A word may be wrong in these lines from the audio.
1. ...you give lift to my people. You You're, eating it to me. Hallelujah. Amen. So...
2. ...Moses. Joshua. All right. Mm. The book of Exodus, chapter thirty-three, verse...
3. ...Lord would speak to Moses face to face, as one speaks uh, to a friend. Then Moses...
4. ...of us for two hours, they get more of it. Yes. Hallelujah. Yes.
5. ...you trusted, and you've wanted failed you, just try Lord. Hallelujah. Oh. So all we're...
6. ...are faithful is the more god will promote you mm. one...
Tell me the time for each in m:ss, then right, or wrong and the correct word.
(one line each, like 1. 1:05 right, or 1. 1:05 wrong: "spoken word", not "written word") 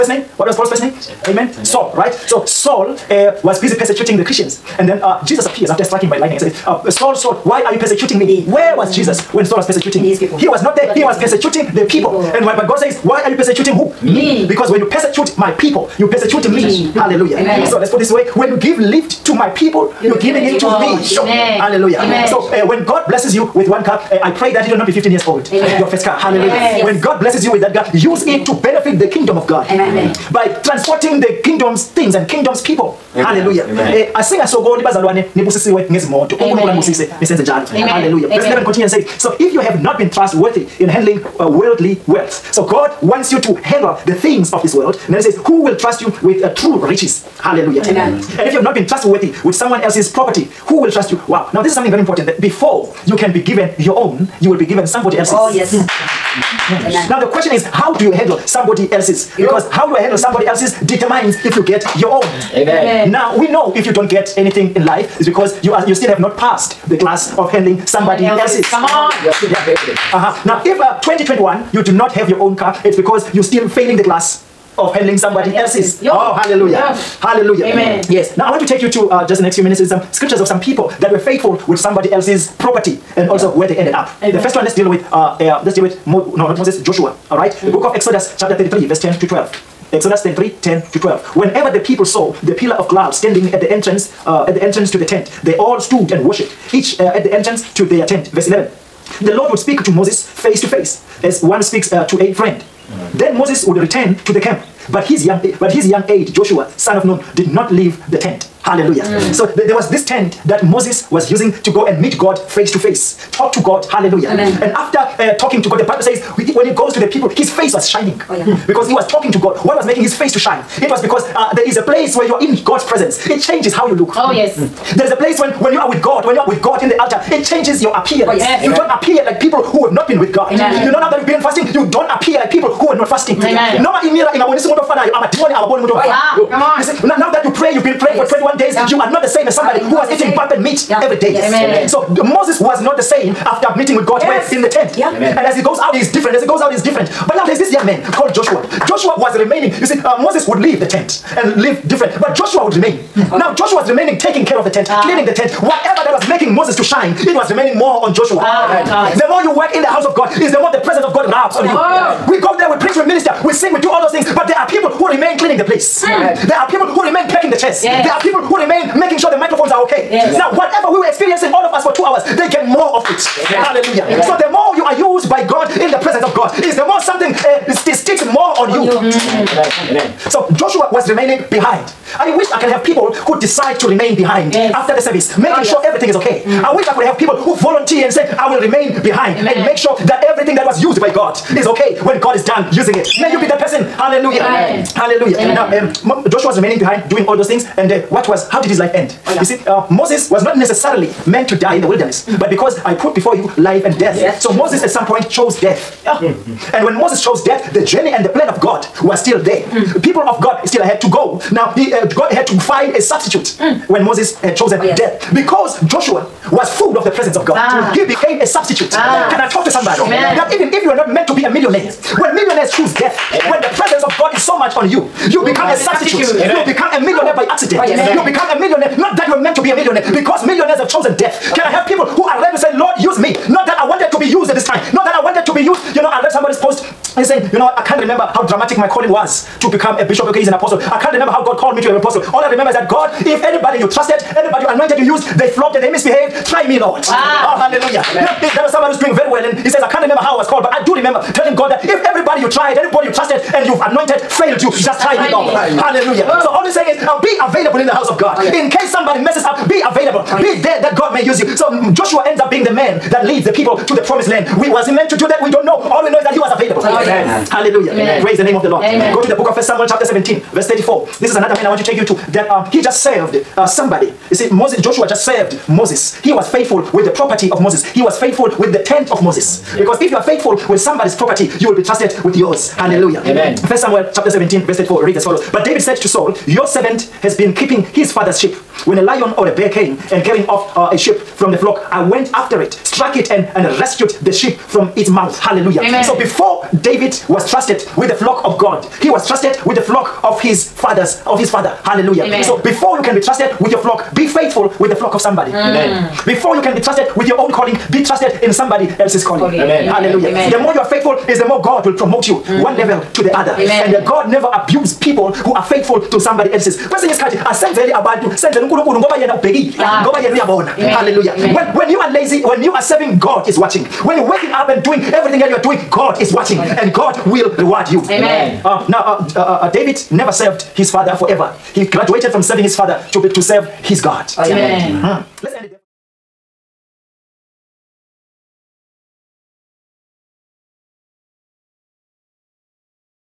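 1. 0:18 wrong: "giving", not "eating"
2. 1:26 right
3. 1:39 right
4. 2:51 right
5. 4:13 wrong: "anointed", not "wanted"
6. 5:10 right.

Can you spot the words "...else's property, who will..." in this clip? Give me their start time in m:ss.
0:49.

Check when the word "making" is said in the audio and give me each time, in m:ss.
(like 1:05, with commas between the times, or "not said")
1:59, 2:36, 2:48, 3:05.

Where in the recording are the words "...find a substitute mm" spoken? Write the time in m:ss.
3:32.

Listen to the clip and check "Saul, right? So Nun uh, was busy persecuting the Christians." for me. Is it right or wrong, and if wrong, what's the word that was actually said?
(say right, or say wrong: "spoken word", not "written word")
wrong: "Saul", not "Nun".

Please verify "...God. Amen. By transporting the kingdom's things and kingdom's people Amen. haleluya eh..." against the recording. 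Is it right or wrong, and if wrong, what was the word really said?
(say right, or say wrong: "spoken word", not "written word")
right.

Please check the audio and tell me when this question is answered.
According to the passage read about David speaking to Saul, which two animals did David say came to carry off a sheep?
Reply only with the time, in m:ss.
4:48.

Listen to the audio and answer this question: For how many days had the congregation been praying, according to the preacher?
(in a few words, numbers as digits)
21.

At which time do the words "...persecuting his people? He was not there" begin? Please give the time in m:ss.
0:09.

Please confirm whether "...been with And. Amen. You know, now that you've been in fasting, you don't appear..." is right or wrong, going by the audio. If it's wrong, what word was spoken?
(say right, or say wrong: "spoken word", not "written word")
wrong: "God", not "And".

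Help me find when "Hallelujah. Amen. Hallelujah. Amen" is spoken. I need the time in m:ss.
3:13.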